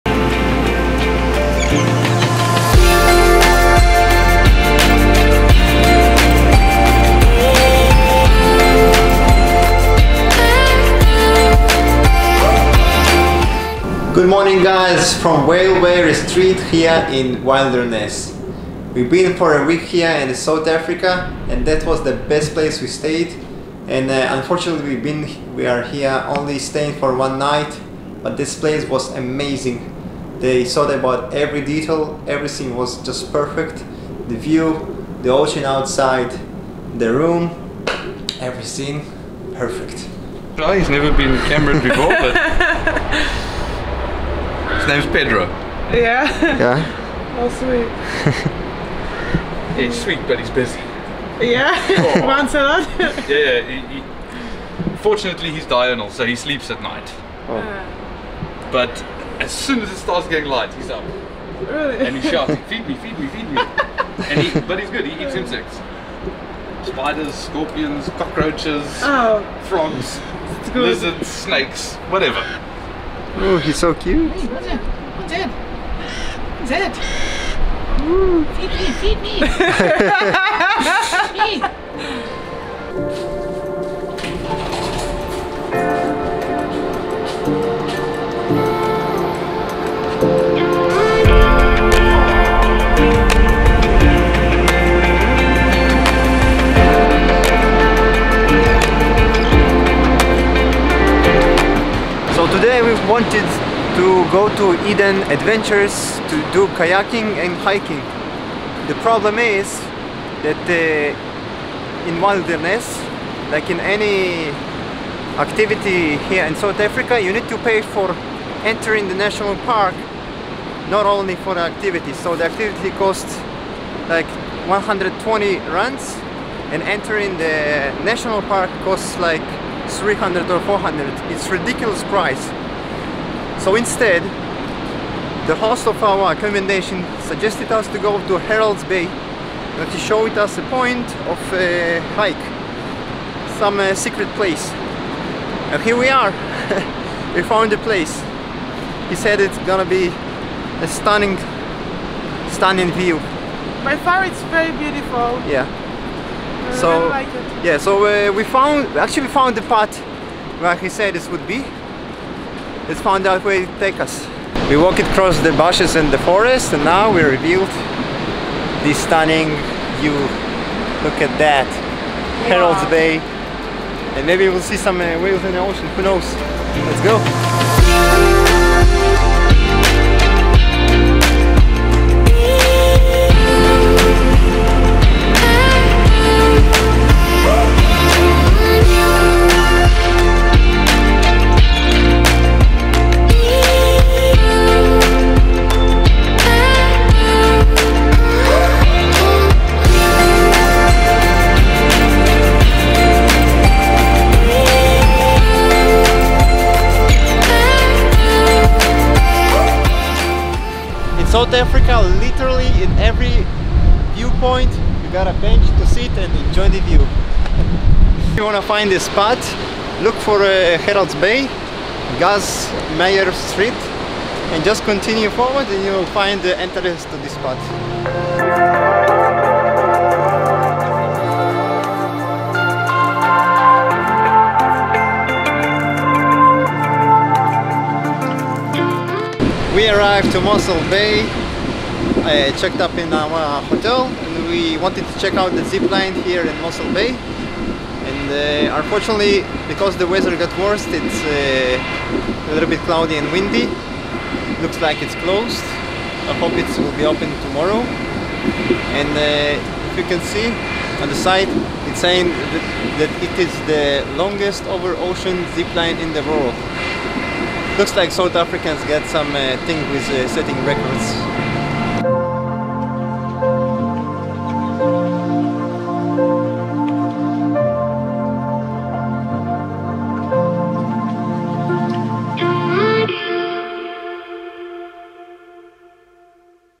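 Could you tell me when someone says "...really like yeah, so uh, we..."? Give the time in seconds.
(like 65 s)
156 s.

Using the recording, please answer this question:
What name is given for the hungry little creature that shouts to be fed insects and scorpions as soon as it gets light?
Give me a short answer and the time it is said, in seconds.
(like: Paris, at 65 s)
Pedro, at 45 s.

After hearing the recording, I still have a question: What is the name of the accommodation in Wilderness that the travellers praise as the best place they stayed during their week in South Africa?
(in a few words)
Whales Way Retreat.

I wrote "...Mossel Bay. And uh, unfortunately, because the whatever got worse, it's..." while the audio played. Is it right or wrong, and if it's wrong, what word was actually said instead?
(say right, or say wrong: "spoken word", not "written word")
wrong: "weather", not "whatever".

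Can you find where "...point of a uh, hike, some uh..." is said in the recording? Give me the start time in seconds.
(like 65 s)
140 s.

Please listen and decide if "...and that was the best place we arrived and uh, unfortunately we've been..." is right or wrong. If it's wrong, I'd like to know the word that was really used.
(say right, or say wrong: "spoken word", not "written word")
wrong: "stayed", not "arrived".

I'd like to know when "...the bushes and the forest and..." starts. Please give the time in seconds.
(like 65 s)
165 s.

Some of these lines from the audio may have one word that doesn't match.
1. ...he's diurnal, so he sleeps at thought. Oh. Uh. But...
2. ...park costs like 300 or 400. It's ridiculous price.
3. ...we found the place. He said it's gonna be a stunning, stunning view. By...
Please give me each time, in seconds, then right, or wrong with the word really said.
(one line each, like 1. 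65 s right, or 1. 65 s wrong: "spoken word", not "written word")
1. 55 s wrong: "night", not "thought"
2. 128 s right
3. 147 s right.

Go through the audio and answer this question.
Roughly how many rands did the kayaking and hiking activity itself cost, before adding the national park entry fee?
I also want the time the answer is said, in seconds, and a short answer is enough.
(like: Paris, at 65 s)
120 rands, at 124 s.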